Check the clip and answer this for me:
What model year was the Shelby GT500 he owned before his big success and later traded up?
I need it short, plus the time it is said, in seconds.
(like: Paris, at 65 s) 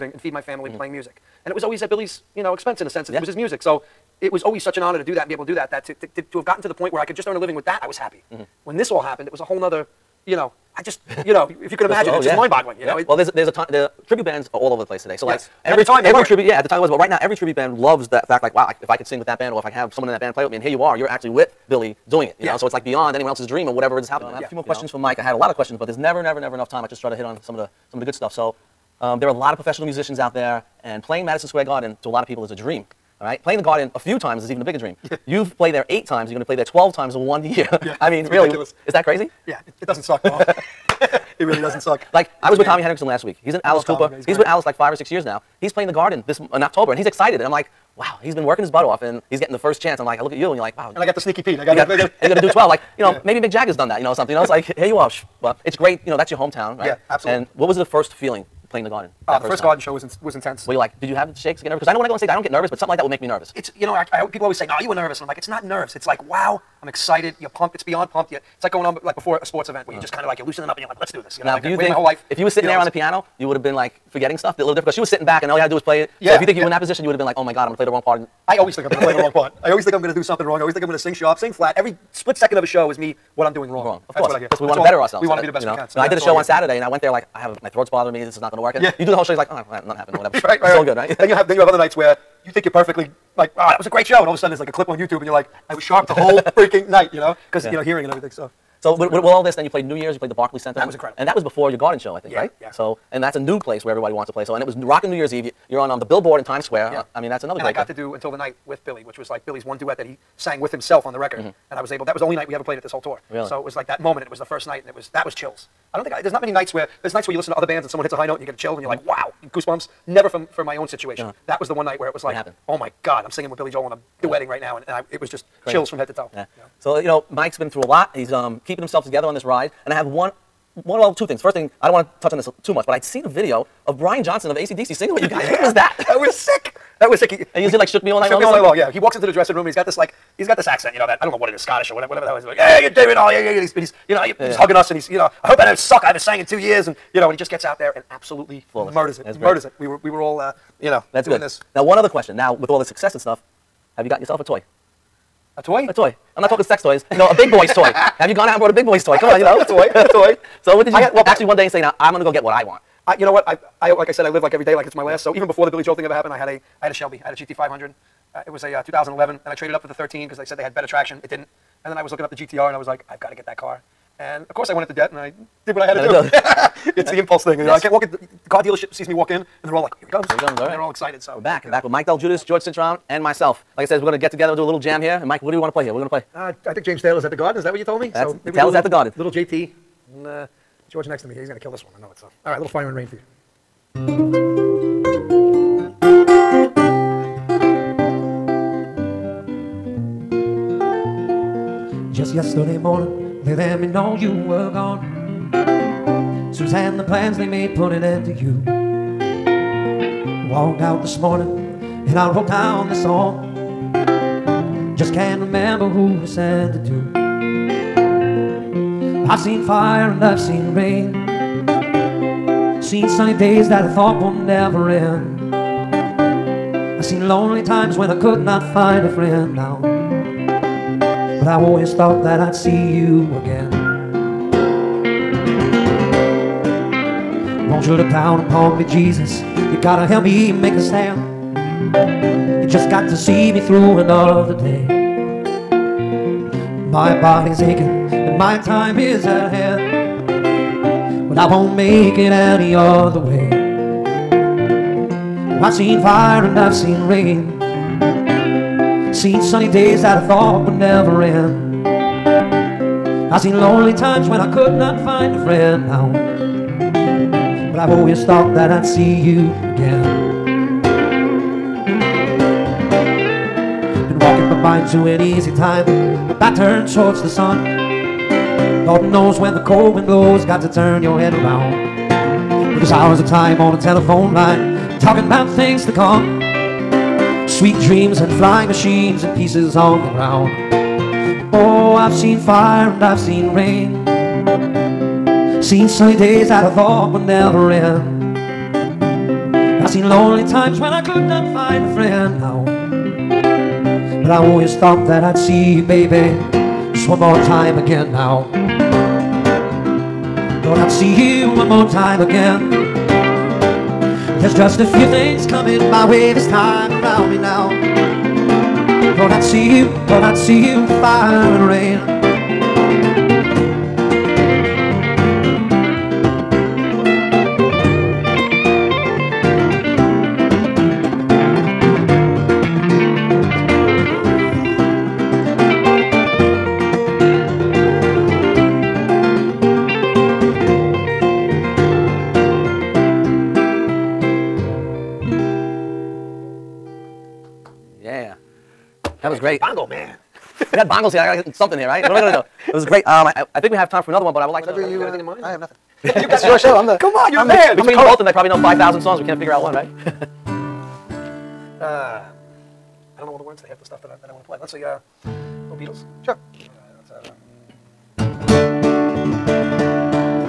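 2011, at 168 s.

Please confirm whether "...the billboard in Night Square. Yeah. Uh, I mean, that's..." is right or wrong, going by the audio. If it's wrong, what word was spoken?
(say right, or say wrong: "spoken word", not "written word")
wrong: "Times", not "Night".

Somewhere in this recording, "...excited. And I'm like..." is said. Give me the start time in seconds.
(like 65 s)
47 s.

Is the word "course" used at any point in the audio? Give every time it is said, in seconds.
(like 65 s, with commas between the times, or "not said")
84 s, 174 s.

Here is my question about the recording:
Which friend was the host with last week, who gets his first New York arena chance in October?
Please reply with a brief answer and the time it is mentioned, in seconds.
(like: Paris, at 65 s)
Tommy Henriksen, at 42 s.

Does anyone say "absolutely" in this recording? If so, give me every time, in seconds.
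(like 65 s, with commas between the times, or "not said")
57 s, 148 s.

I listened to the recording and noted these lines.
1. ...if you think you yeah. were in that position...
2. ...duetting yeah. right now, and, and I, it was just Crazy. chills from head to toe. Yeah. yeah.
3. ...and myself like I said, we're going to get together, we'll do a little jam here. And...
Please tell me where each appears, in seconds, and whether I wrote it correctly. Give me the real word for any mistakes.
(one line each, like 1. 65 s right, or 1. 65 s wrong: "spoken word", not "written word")
1. 76 s right
2. 124 s right
3. 183 s right.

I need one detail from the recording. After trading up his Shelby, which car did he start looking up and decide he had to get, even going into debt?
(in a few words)
GTR.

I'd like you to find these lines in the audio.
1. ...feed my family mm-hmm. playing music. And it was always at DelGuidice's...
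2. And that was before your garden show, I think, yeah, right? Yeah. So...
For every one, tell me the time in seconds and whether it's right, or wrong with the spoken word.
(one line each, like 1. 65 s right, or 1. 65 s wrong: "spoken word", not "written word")
1. 0 s wrong: "Billy", not "DelGuidice"
2. 101 s right.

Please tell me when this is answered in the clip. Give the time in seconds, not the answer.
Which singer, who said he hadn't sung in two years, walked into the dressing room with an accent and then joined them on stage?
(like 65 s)
133 s.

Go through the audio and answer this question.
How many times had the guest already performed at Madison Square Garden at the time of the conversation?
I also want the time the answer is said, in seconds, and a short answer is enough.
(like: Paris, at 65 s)
8, at 35 s.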